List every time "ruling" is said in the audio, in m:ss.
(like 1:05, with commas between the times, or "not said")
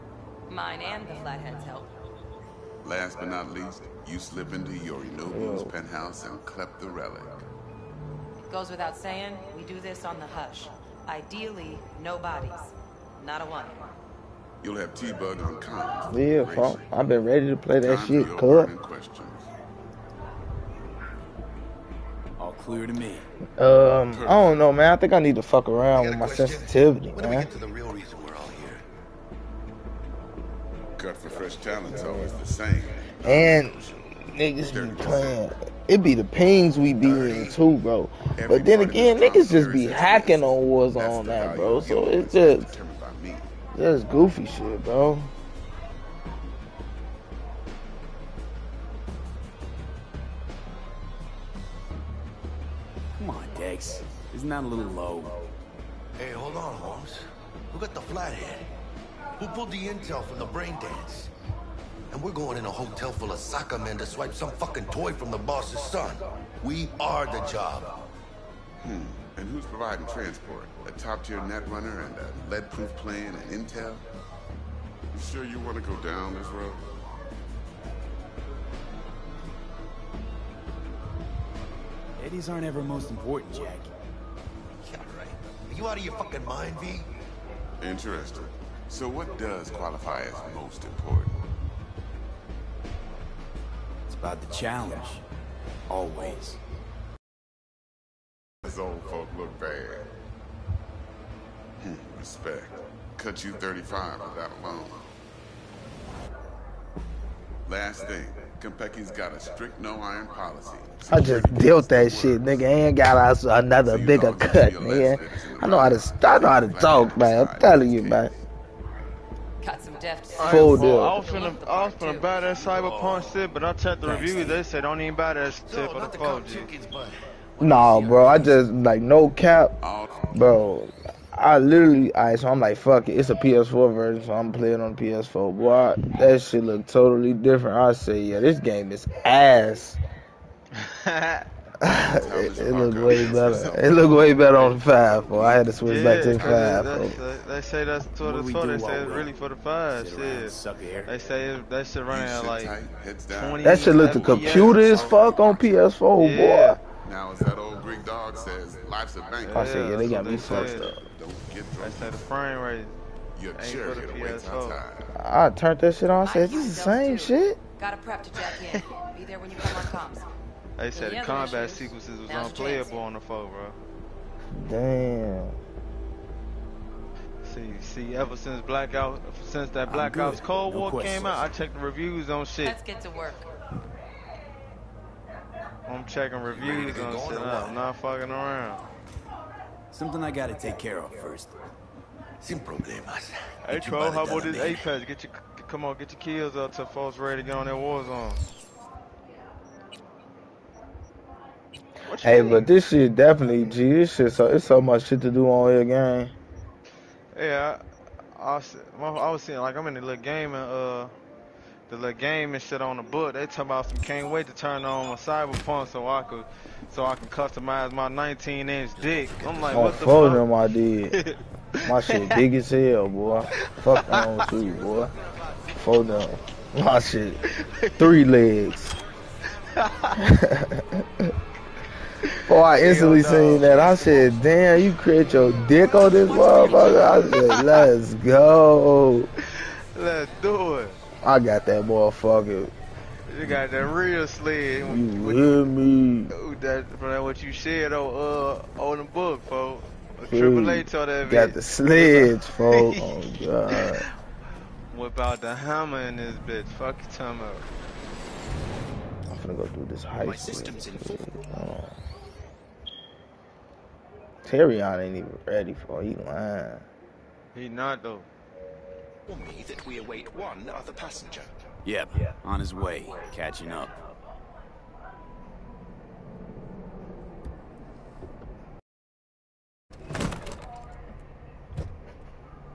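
not said.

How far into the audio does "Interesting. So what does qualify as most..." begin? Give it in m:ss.
1:27.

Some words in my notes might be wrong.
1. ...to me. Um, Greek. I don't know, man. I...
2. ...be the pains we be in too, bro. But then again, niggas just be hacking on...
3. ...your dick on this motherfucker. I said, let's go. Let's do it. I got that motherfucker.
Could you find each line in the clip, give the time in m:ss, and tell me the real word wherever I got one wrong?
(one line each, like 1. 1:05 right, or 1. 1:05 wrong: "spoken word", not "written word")
1. 0:22 wrong: "Perfect", not "Greek"
2. 0:36 right
3. 3:55 right.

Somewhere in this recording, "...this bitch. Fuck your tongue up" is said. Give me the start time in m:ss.
4:16.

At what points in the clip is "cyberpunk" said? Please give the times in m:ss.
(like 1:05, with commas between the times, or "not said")
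2:02, 3:35.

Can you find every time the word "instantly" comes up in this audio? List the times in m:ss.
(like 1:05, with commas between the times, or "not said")
3:52.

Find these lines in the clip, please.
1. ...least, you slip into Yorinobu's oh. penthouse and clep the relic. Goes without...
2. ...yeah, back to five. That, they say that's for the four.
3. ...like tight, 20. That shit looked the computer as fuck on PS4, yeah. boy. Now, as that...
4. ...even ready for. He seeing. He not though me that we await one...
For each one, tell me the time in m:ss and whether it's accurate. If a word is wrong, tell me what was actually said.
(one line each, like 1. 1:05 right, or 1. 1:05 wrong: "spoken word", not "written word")
1. 0:03 right
2. 2:25 right
3. 2:32 right
4. 4:25 wrong: "lying", not "seeing".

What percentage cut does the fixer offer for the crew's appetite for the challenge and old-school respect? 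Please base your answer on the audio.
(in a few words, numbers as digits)
35.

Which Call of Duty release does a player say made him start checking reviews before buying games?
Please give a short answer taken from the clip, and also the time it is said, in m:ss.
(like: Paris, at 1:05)
Black Ops Cold War, at 2:59.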